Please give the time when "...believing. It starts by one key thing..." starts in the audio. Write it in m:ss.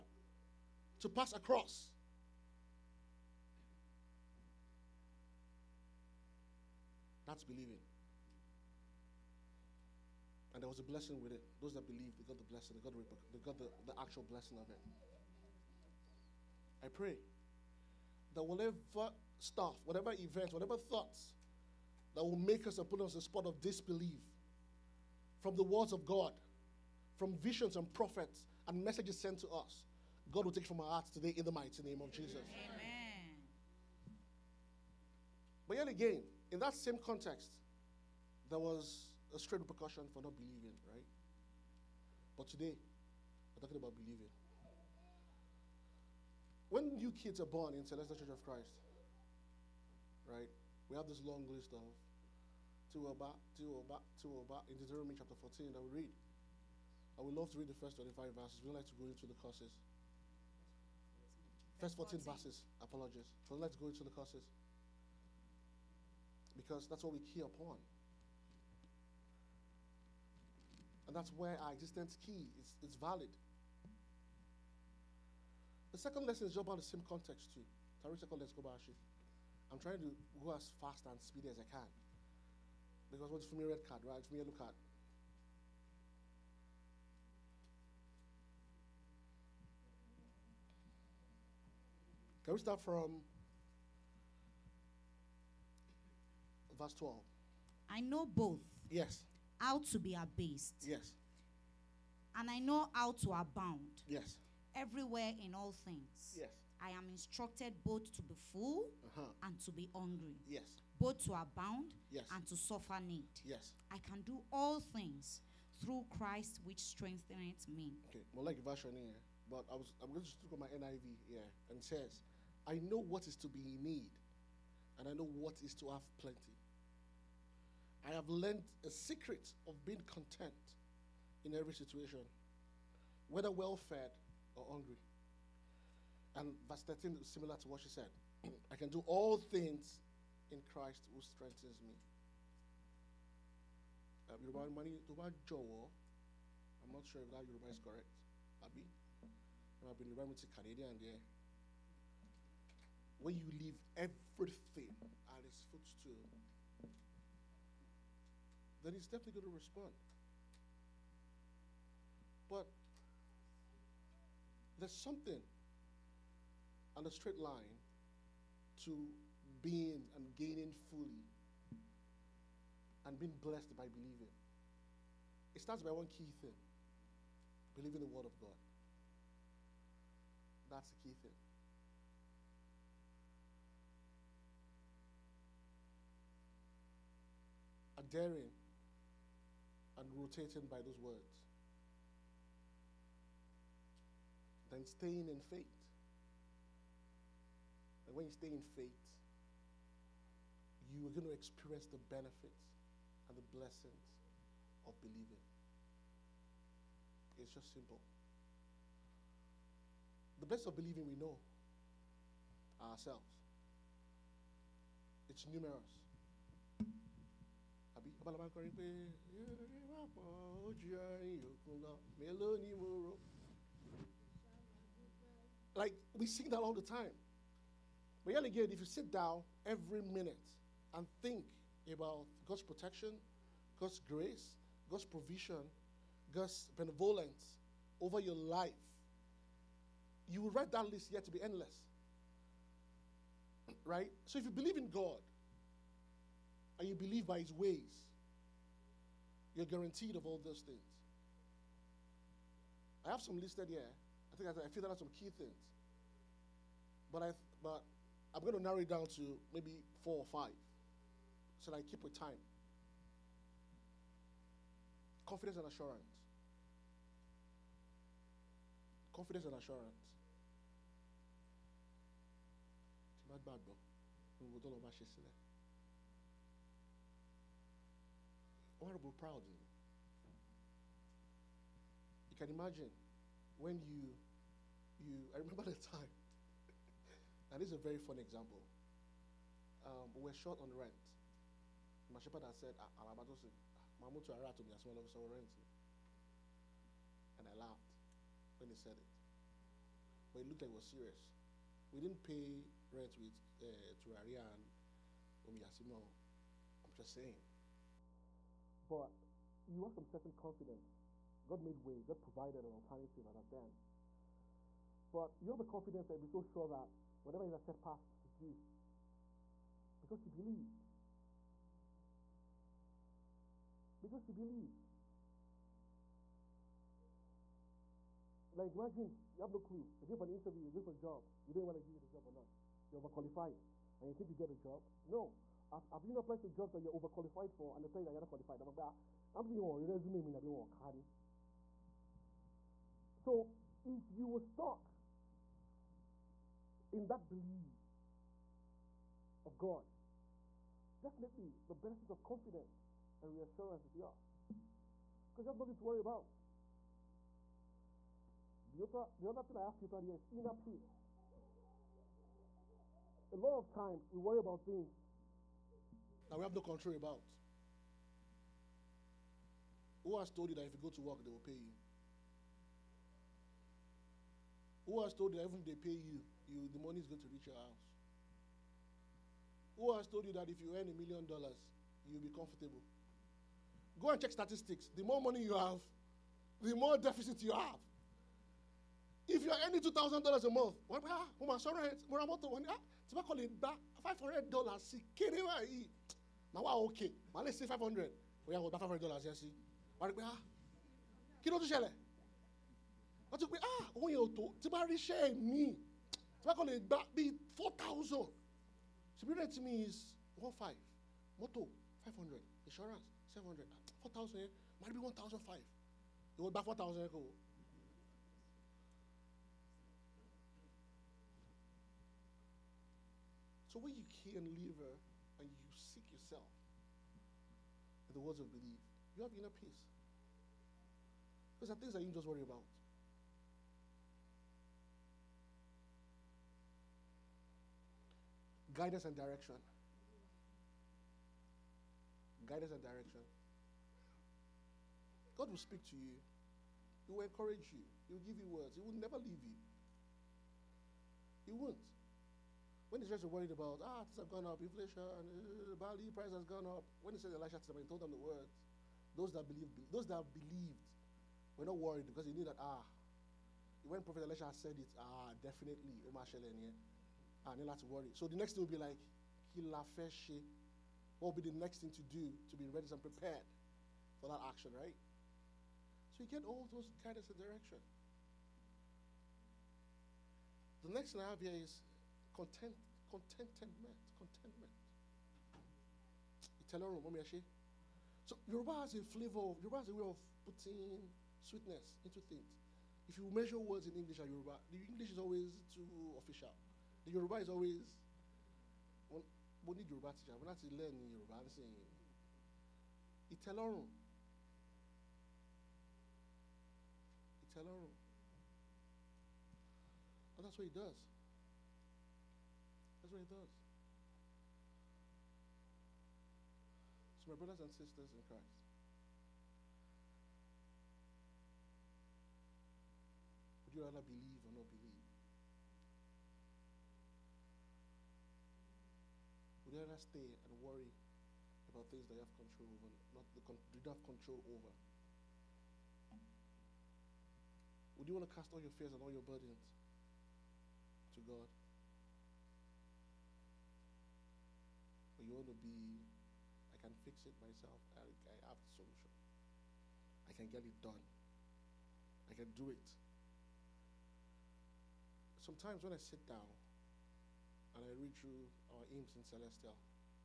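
2:53.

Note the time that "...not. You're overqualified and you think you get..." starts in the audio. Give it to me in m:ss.
5:32.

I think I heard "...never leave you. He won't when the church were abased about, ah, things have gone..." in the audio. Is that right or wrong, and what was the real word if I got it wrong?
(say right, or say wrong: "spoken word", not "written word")
wrong: "worried", not "abased".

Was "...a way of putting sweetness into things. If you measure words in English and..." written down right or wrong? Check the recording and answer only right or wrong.
right.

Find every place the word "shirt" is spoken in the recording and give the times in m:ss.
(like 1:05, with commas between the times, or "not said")
not said.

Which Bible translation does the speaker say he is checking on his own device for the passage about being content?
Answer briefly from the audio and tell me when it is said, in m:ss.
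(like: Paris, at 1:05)
NIV, at 2:00.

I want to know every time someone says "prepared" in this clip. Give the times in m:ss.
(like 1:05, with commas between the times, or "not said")
7:53.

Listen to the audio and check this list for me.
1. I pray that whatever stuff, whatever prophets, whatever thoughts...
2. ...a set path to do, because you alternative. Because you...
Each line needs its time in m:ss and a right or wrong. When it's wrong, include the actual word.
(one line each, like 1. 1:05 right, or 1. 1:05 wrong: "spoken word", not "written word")
1. 0:16 wrong: "events", not "prophets"
2. 5:17 wrong: "believe", not "alternative".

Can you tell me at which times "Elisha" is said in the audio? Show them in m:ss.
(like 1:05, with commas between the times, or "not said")
7:37, 7:44.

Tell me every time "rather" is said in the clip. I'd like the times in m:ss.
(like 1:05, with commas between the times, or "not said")
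8:43, 8:49.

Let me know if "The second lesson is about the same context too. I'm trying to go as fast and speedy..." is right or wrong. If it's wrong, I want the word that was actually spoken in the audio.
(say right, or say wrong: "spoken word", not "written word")
right.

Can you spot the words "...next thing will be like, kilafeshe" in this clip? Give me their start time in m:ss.
7:48.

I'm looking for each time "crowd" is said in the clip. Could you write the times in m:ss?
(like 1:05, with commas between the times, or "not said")
not said.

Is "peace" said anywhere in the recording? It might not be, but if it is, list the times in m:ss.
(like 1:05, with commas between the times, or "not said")
6:00, 7:09.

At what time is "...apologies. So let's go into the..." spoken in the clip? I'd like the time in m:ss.
1:02.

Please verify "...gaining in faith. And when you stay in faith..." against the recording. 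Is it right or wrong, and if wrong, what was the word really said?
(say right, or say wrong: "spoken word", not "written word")
wrong: "staying", not "gaining".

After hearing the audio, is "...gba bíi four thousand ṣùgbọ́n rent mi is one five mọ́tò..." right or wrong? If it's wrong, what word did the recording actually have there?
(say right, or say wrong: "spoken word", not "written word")
right.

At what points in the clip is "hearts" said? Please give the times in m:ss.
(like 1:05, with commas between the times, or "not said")
0:30.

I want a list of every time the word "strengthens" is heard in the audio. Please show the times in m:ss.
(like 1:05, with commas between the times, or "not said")
1:56, 2:21.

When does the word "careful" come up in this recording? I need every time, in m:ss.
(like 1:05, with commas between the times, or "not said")
not said.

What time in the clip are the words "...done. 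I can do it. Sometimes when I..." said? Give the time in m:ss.
9:10.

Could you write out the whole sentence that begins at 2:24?
Um, money, Yoruba Jowo, I'm not sure if that Yoruba is correct.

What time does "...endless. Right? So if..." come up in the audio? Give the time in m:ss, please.
4:01.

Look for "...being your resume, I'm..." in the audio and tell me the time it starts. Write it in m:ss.
5:39.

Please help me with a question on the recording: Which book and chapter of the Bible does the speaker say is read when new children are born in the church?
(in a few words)
Deuteronomy chapter 14.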